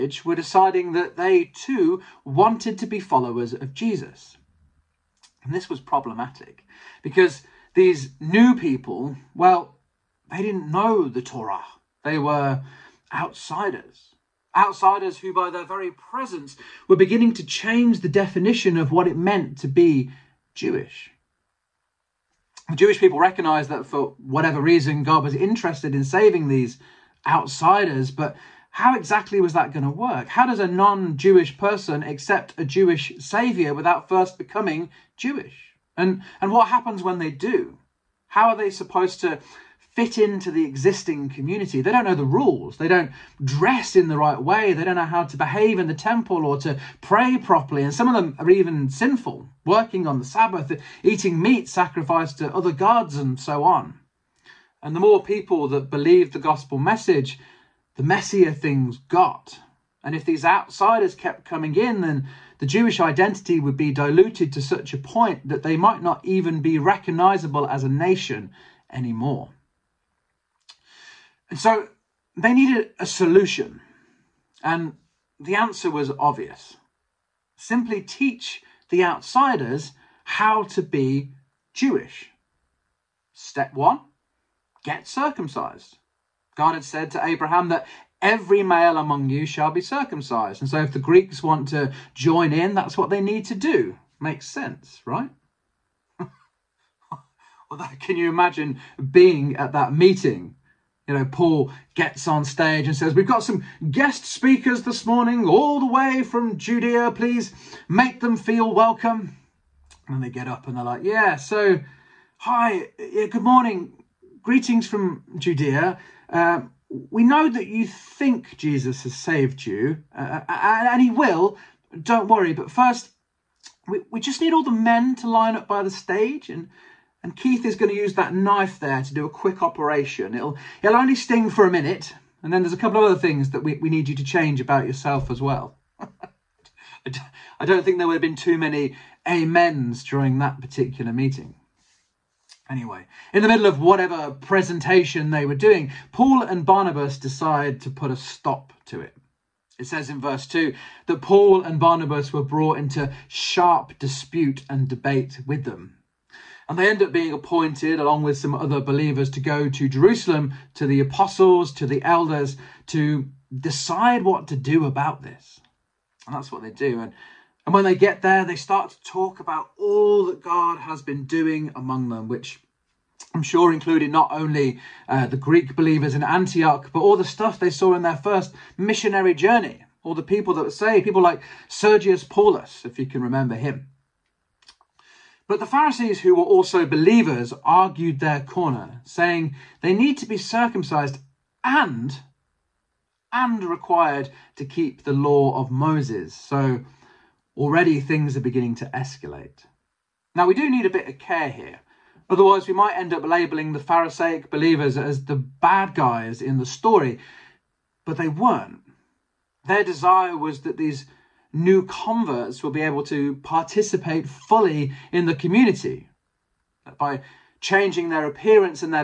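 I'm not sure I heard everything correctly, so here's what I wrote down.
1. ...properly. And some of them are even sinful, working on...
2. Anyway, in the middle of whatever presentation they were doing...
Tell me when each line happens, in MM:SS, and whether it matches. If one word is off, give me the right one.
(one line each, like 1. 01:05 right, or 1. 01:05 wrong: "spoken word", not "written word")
1. 00:47 right
2. 02:22 right.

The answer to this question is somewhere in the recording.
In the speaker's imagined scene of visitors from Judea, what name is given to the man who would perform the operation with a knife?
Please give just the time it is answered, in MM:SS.
02:07.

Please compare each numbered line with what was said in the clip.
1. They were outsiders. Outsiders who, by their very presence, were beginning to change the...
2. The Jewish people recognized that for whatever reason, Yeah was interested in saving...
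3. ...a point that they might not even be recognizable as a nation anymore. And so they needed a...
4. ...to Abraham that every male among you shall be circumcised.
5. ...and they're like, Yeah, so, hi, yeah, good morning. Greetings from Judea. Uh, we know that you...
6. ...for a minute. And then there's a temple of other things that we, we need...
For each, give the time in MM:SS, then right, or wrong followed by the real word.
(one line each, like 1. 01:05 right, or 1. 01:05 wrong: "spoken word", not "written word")
1. 00:12 right
2. 00:22 wrong: "God", not "Yeah"
3. 01:04 right
4. 01:27 right
5. 01:50 right
6. 02:11 wrong: "couple", not "temple".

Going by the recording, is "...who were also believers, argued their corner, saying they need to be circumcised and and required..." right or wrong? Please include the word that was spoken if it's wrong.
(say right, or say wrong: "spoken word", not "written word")
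right.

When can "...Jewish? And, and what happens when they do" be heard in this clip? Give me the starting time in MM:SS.
00:35.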